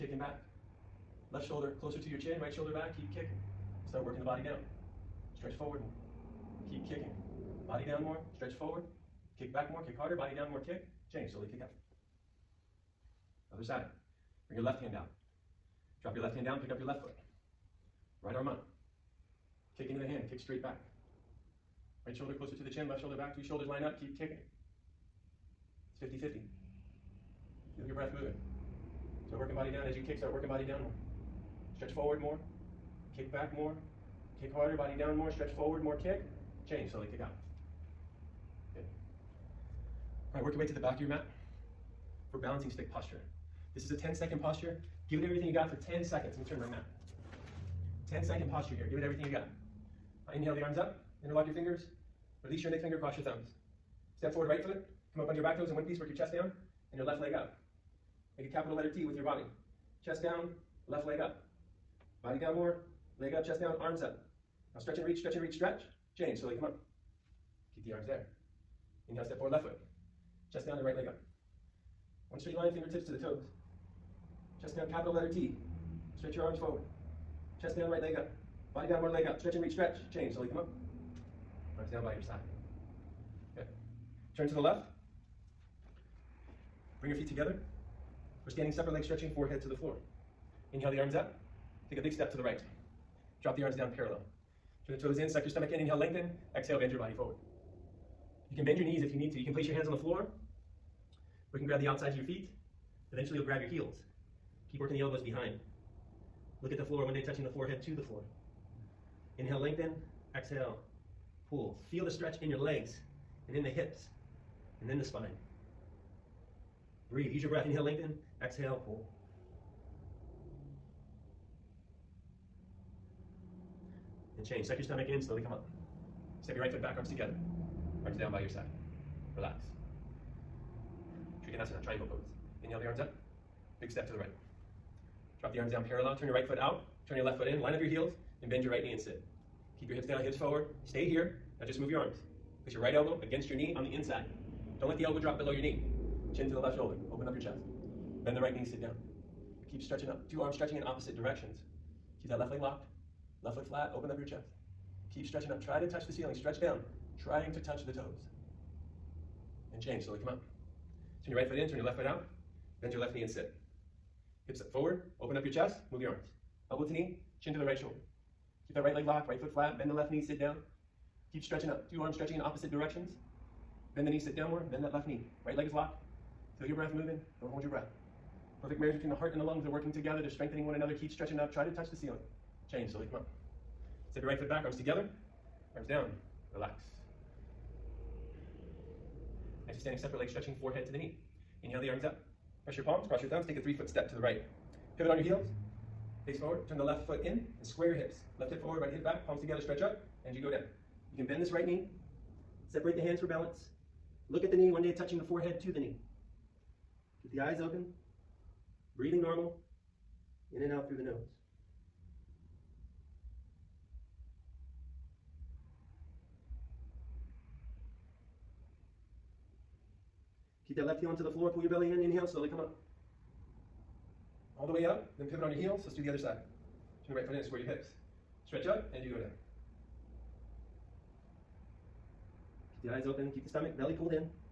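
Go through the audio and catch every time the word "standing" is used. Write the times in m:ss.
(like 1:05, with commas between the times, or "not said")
1:28, 3:09.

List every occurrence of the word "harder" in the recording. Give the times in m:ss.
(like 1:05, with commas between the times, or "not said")
0:09, 0:34.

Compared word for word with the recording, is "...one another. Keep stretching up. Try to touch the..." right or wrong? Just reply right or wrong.
right.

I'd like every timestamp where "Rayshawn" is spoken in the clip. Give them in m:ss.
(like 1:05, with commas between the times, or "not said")
not said.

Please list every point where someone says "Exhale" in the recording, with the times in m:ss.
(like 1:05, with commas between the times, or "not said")
1:36, 1:50, 1:58.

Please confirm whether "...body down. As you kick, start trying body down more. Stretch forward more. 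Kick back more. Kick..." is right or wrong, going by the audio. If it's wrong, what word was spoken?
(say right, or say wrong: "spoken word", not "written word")
wrong: "working", not "trying".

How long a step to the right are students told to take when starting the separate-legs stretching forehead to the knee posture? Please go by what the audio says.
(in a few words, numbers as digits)
3 feet.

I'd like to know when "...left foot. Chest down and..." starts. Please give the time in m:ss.
1:09.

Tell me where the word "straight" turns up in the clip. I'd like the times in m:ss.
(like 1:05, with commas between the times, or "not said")
0:20, 1:12.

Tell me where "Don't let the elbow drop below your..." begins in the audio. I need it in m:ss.
2:24.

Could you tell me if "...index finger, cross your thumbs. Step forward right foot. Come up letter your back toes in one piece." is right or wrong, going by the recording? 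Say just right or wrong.
wrong.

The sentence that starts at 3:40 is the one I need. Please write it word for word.
that left heel onto the floor, pull your belly in, inhale, slowly come up.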